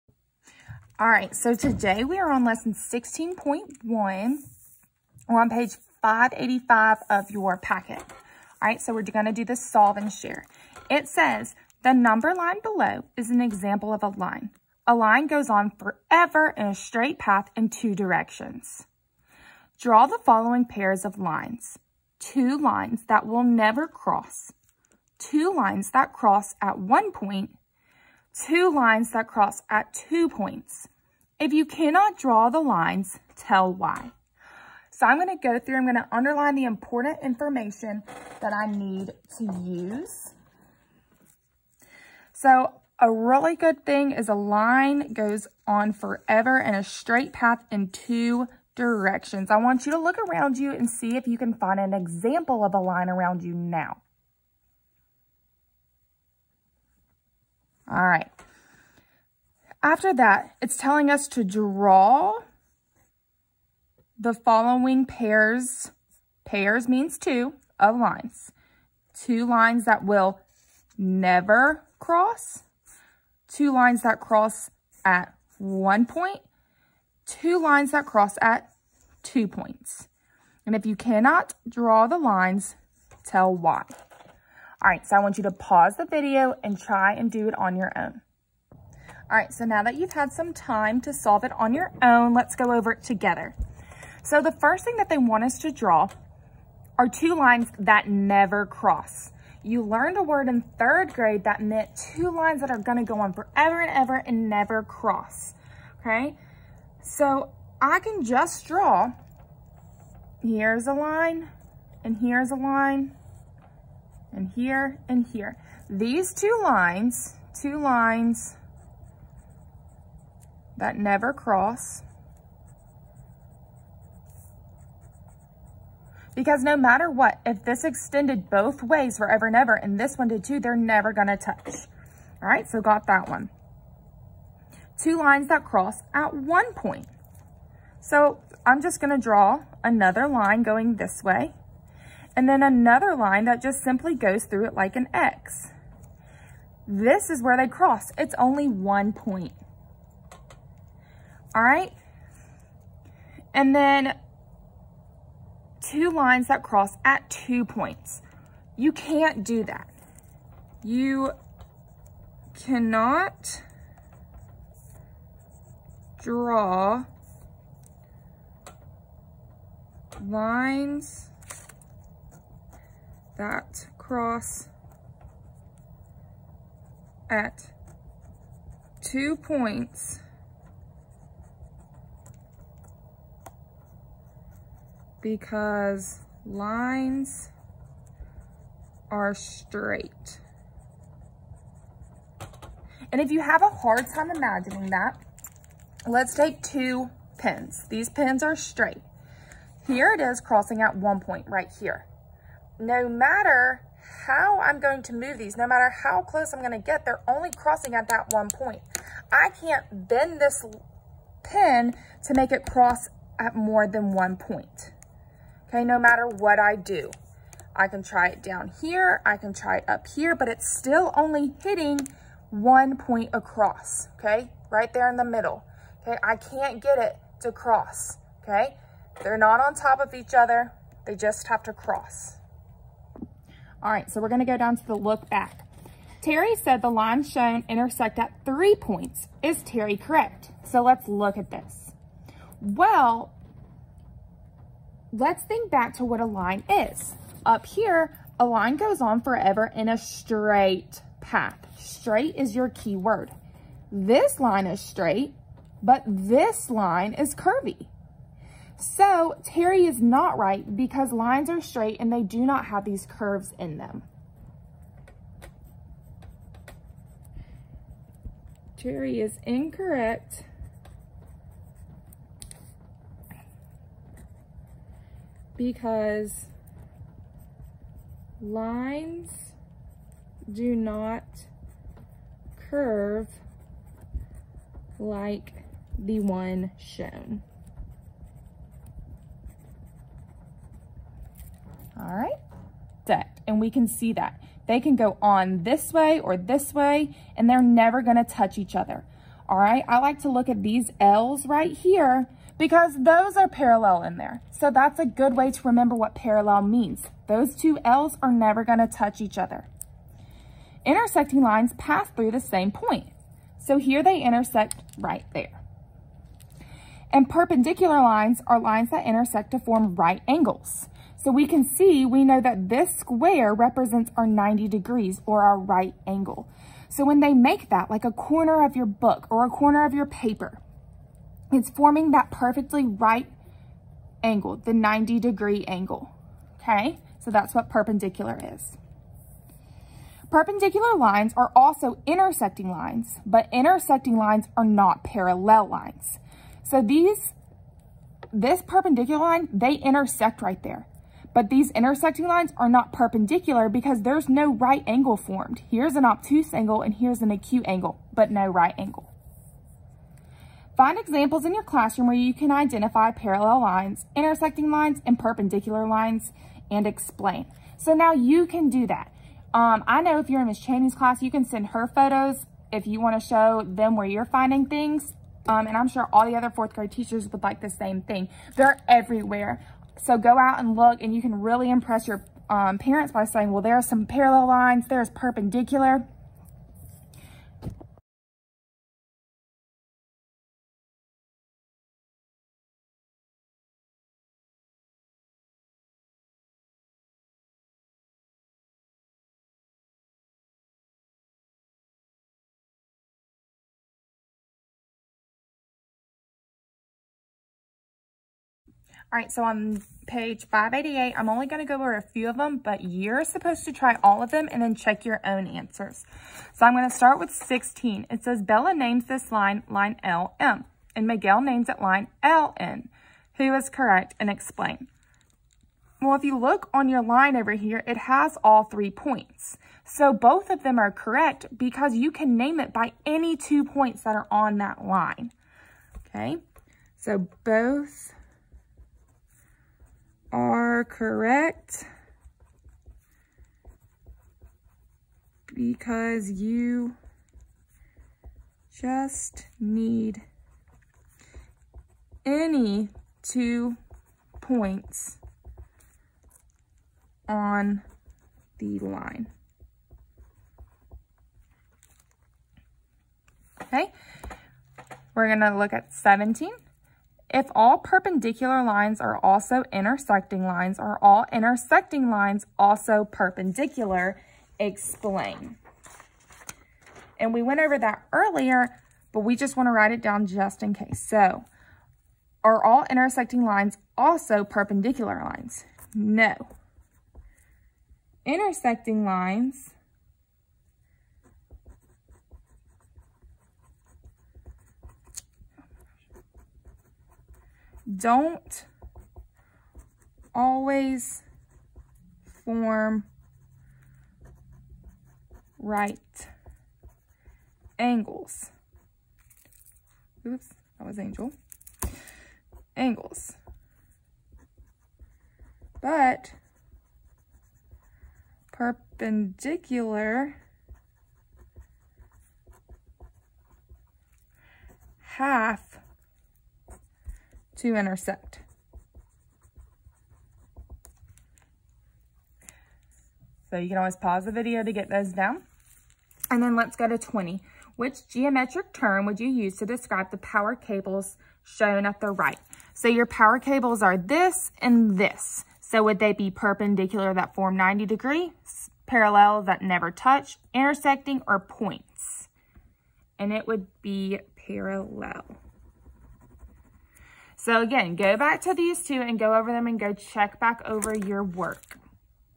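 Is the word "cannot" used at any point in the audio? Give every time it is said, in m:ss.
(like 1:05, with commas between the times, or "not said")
0:31, 1:20, 2:42.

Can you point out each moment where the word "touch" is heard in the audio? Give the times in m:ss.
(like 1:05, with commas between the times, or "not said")
2:11, 4:58, 5:08, 9:09.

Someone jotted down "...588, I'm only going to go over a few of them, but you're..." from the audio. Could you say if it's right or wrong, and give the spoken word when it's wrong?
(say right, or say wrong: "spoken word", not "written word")
right.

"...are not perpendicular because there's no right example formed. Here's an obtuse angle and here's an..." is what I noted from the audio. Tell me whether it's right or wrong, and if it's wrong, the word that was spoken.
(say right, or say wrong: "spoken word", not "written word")
wrong: "angle", not "example".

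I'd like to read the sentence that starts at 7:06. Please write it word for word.
Well, if you look on your line over here, it has all three points.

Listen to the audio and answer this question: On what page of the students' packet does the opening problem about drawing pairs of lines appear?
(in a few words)
585.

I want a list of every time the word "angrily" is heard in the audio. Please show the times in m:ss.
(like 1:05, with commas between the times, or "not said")
not said.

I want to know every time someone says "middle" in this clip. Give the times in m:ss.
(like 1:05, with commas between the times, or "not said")
3:45.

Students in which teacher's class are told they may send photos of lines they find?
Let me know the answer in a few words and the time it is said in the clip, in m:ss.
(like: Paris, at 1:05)
Miss Cheney, at 6:10.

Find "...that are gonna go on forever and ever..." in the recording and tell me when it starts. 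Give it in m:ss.
1:42.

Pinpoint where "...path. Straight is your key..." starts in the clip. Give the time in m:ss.
4:11.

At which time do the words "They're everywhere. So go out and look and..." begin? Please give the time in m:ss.
6:18.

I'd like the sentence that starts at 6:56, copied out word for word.
So I'm going to start with 16.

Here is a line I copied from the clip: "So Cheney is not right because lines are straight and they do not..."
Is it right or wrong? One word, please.
wrong.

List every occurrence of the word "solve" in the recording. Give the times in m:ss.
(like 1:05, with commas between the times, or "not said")
0:09, 1:31.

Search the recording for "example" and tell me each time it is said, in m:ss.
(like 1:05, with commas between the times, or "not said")
0:13, 0:51, 6:00.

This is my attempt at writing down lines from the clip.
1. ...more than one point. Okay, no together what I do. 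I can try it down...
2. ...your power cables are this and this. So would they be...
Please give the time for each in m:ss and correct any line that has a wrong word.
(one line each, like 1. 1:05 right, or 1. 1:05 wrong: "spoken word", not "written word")
1. 3:33 wrong: "matter", not "together"
2. 9:02 right.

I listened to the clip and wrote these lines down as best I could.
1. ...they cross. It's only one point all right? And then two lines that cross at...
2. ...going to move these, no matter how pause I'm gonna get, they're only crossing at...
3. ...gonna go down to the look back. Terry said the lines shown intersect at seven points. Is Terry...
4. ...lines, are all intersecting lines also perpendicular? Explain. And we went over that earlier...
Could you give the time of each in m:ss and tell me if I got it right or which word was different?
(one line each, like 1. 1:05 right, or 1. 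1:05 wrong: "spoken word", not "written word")
1. 2:27 right
2. 3:24 wrong: "close", not "pause"
3. 3:54 wrong: "three", not "seven"
4. 7:50 right.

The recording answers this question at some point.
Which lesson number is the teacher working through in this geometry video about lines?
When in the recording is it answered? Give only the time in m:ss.
0:02.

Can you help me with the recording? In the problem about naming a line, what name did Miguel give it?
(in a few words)
line LN.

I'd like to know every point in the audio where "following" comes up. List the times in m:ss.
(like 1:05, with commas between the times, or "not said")
0:20, 1:04.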